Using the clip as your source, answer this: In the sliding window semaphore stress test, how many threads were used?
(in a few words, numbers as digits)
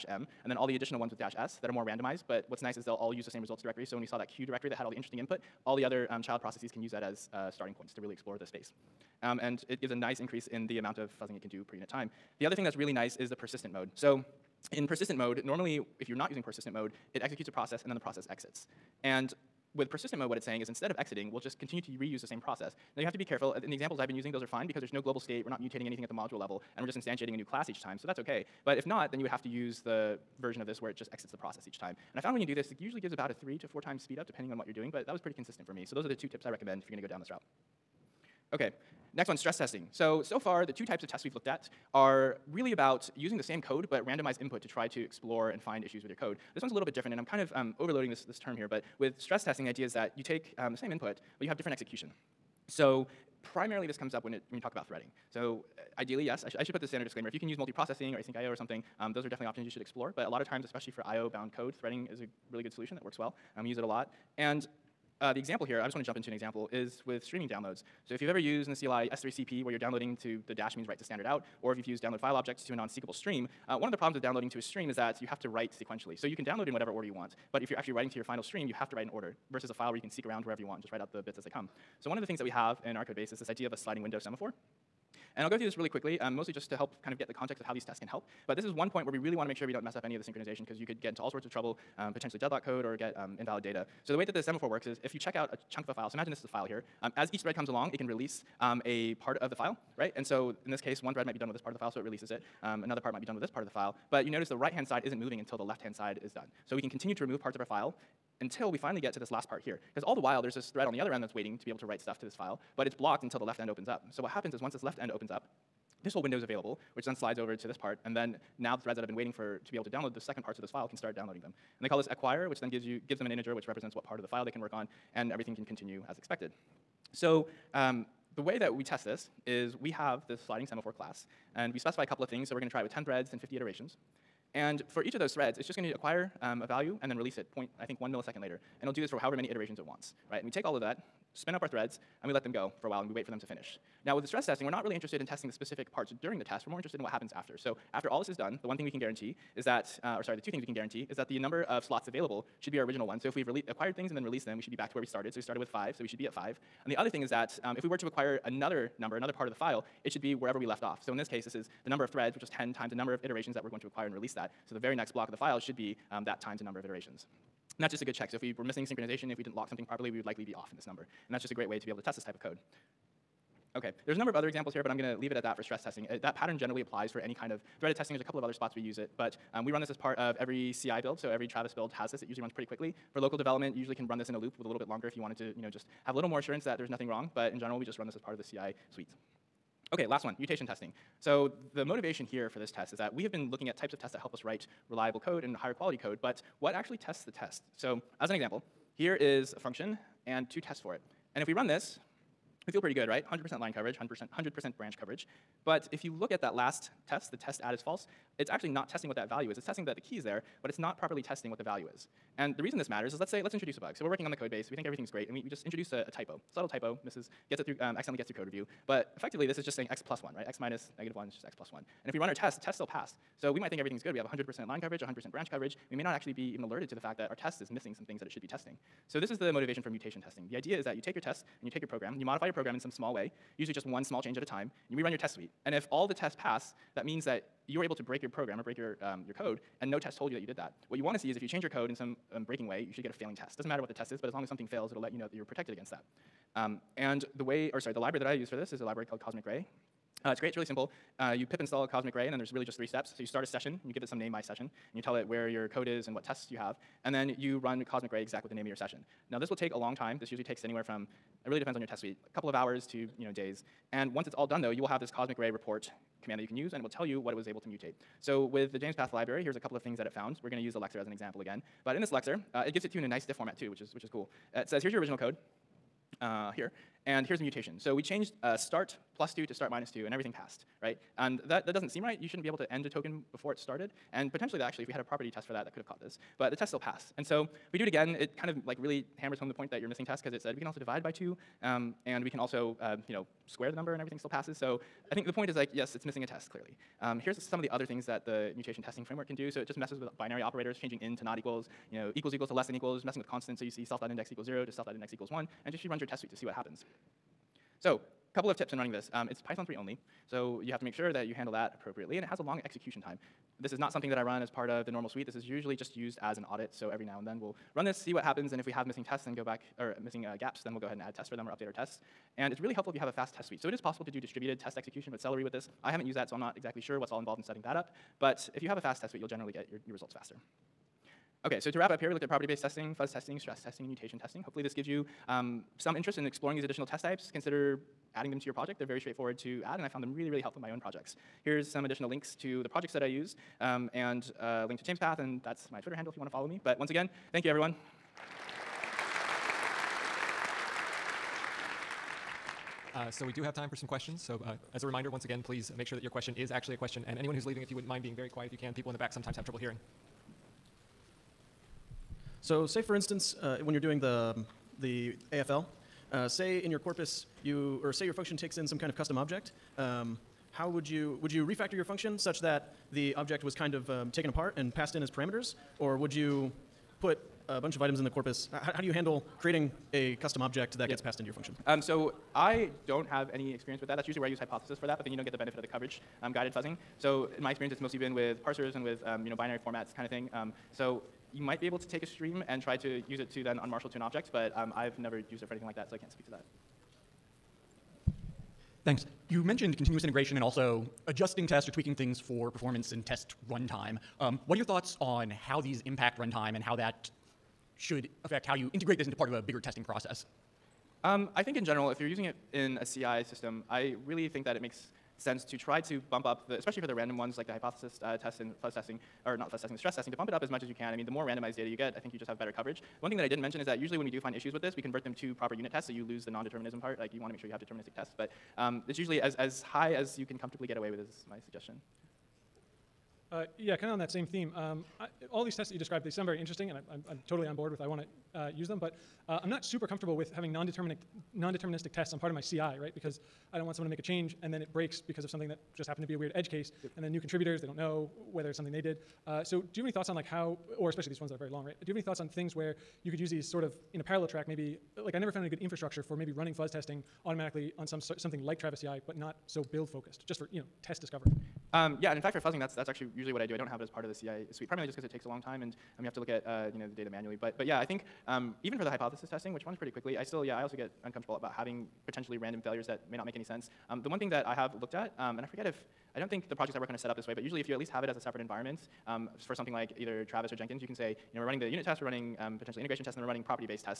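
10.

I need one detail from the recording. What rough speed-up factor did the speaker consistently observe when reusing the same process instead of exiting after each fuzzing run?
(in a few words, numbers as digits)
3 to 4 times.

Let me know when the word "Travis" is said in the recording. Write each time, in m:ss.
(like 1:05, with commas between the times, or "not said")
3:01, 7:38, 8:00.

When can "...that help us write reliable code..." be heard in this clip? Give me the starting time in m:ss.
3:14.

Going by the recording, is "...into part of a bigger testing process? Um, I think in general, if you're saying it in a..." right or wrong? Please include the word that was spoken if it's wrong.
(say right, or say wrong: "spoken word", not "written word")
wrong: "using", not "saying".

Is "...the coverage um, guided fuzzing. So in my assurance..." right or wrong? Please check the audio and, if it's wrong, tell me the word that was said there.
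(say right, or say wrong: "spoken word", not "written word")
wrong: "experience", not "assurance".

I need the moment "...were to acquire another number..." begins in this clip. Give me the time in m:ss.
2:37.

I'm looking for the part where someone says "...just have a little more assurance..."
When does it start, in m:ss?
3:05.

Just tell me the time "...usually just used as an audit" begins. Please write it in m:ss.
5:15.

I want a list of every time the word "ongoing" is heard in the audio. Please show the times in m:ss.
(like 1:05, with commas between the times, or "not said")
not said.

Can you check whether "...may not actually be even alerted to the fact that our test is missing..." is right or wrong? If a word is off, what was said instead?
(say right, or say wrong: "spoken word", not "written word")
right.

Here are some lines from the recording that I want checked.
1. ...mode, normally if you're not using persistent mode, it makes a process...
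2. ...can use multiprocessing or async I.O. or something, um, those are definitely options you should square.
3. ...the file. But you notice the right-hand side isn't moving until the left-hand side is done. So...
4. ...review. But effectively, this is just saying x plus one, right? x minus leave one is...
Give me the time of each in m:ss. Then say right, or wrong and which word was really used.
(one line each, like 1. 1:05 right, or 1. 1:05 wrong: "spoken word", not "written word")
1. 0:15 wrong: "executes", not "makes"
2. 0:57 wrong: "explore", not "square"
3. 1:43 right
4. 3:38 wrong: "negative", not "leave".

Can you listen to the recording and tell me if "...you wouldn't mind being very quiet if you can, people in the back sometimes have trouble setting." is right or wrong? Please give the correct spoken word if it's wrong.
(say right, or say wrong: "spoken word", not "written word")
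wrong: "hearing", not "setting".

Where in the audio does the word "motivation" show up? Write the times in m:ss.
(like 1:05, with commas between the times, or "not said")
3:11, 3:49.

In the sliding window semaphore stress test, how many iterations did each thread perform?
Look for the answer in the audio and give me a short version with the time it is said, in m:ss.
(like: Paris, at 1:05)
50, at 2:13.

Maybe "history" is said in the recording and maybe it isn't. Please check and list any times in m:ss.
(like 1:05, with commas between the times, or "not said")
not said.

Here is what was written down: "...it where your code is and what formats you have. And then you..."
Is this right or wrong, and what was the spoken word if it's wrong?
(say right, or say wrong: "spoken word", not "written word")
wrong: "tests", not "formats".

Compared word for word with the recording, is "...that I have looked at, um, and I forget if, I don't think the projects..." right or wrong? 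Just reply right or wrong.
right.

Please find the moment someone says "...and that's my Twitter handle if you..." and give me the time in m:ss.
5:45.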